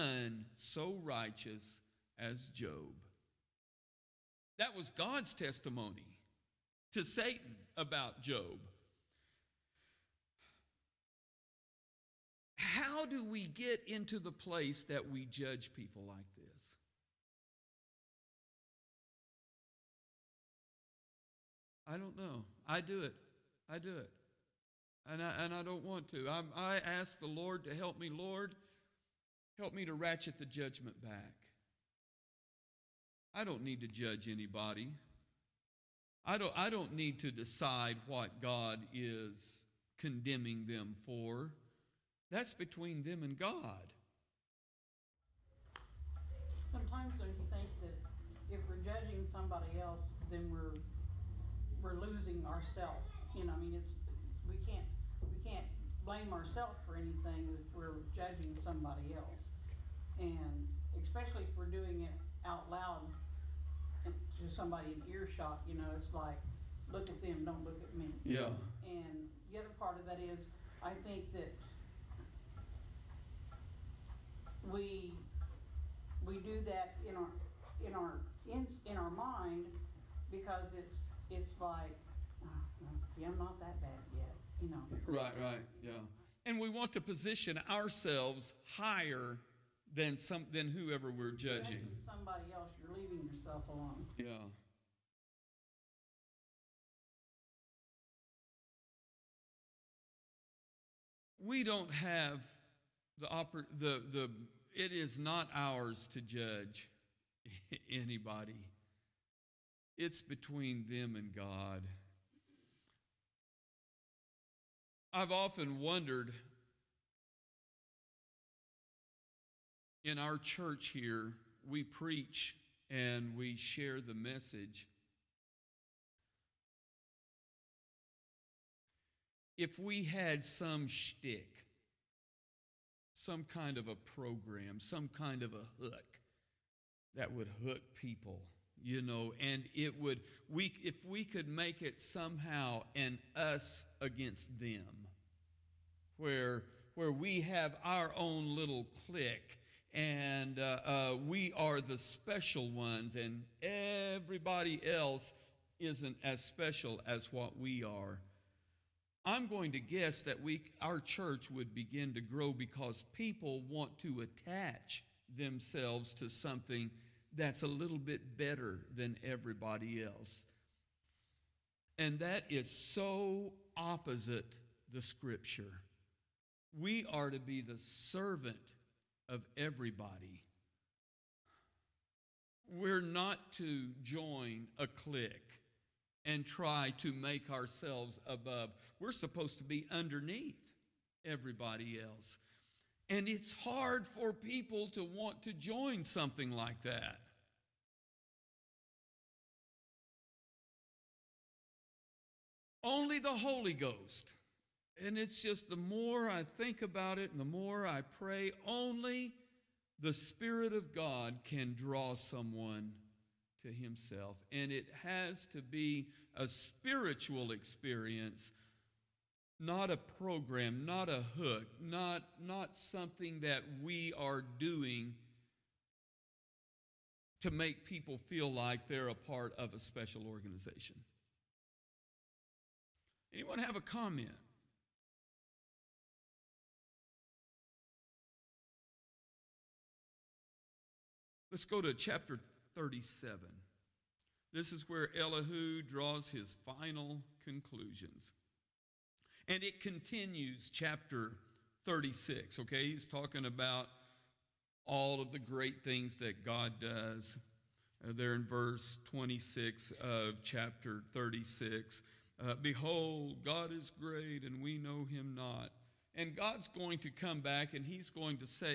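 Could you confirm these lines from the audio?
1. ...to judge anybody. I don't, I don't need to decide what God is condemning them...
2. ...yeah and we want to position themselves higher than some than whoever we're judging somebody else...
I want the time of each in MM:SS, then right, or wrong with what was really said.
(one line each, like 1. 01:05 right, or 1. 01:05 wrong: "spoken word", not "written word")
1. 00:33 right
2. 01:25 wrong: "ourselves", not "themselves".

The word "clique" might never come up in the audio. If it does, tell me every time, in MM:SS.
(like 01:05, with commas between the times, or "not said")
02:28, 03:04.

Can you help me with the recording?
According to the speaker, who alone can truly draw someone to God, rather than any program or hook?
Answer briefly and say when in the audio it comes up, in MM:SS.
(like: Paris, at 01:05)
The Holy Ghost, at 03:23.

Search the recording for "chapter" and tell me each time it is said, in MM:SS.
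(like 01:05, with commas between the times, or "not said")
04:01, 04:10, 04:20.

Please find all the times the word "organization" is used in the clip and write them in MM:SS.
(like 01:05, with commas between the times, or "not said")
03:50.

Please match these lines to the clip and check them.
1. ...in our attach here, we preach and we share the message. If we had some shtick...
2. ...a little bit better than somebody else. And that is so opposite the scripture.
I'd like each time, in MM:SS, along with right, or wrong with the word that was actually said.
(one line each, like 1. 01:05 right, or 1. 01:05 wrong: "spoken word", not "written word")
1. 02:00 wrong: "church", not "attach"
2. 02:47 wrong: "everybody", not "somebody".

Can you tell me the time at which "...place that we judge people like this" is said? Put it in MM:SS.
00:14.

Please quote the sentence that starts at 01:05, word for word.
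You know, it's like look at them, don't look at me.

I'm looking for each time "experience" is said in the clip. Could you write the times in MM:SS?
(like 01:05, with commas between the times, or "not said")
03:37.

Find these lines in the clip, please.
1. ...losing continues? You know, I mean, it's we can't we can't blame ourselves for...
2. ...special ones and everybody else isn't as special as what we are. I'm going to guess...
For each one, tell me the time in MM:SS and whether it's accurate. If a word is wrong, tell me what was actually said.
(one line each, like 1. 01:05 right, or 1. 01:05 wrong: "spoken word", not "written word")
1. 00:51 wrong: "ourselves", not "continues"
2. 02:31 right.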